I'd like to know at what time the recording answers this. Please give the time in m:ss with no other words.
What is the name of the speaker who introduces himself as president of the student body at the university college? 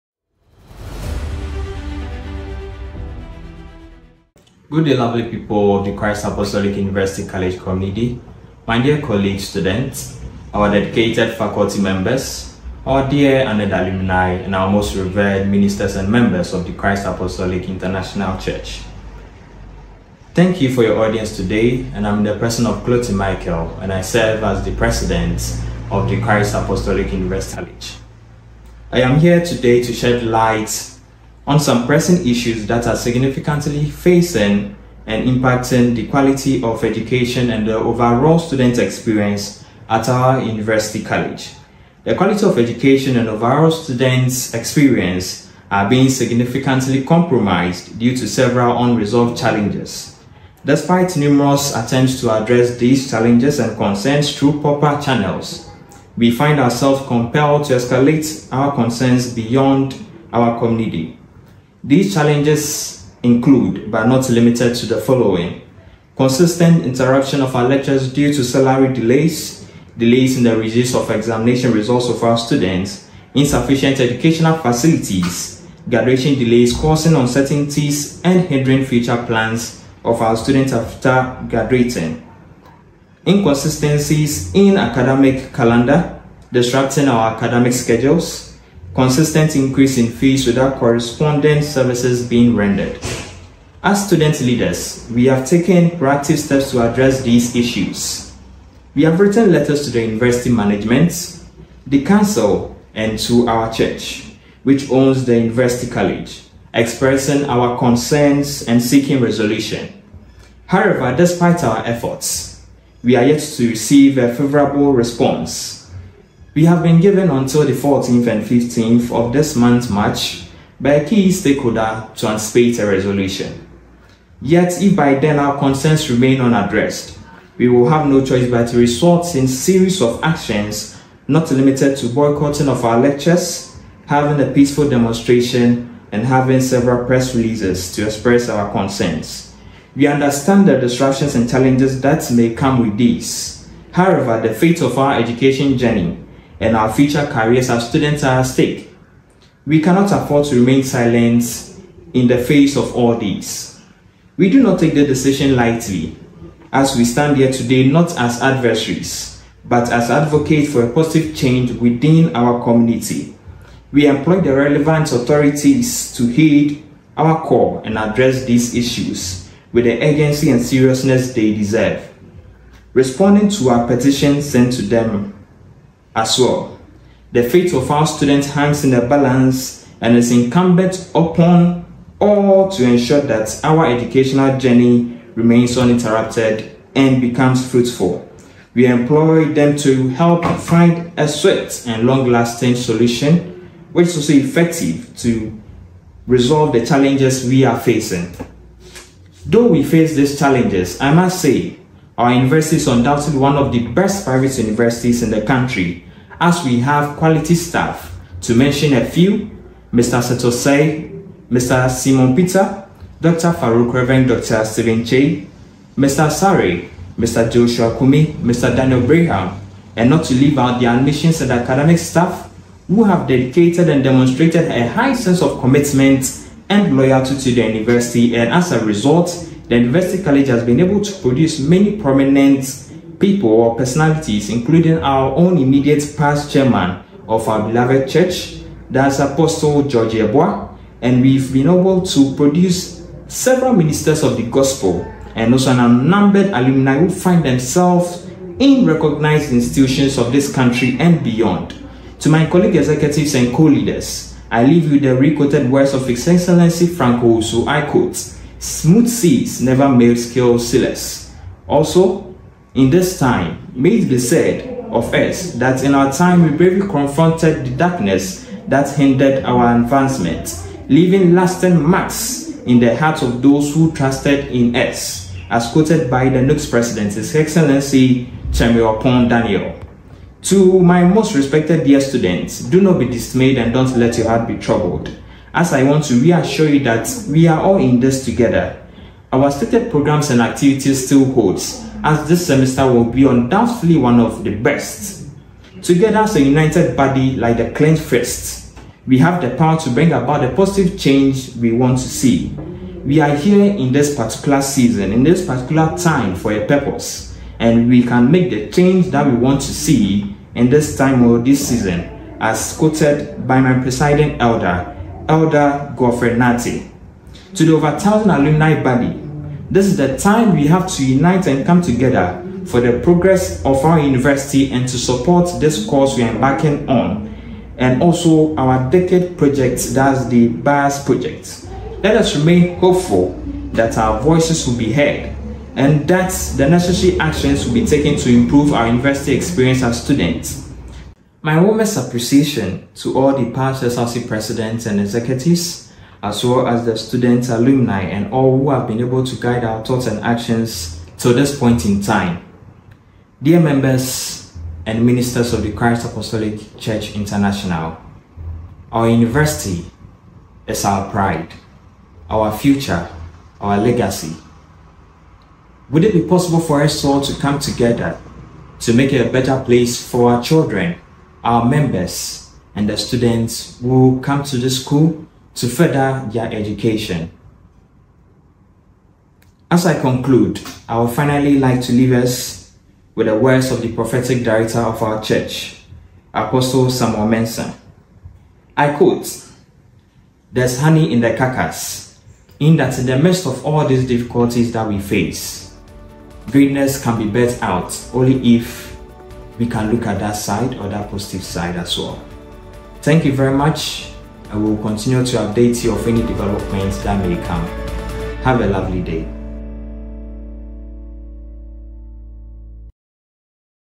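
0:22.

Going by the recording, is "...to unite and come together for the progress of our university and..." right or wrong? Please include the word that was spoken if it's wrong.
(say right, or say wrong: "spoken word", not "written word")
right.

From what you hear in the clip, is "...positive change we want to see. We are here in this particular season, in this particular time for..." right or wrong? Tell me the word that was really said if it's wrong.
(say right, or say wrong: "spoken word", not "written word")
right.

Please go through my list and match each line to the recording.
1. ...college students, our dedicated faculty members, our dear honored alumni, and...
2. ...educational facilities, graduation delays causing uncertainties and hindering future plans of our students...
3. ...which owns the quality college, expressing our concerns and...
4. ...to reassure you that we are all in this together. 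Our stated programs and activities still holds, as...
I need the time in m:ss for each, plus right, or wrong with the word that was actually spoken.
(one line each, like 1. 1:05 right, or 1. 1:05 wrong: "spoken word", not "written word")
1. 0:09 right
2. 1:13 right
3. 1:44 wrong: "university", not "quality"
4. 4:46 right.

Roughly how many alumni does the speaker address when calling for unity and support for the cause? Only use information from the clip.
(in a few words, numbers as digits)
over 1,000.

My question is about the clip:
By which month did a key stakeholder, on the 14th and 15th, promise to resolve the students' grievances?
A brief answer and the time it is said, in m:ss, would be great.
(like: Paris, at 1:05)
March, at 1:59.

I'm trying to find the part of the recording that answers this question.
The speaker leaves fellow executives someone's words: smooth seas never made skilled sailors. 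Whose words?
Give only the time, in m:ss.
4:16.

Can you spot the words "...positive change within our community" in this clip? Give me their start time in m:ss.
2:40.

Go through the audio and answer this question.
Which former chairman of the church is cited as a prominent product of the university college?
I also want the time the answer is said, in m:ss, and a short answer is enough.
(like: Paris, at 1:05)
Apostle George Eboa, at 3:59.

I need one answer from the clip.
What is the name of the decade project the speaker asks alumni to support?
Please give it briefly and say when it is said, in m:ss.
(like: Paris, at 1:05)
BIAS project, at 5:30.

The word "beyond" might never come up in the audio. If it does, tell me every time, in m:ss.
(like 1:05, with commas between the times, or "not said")
0:59, 4:11.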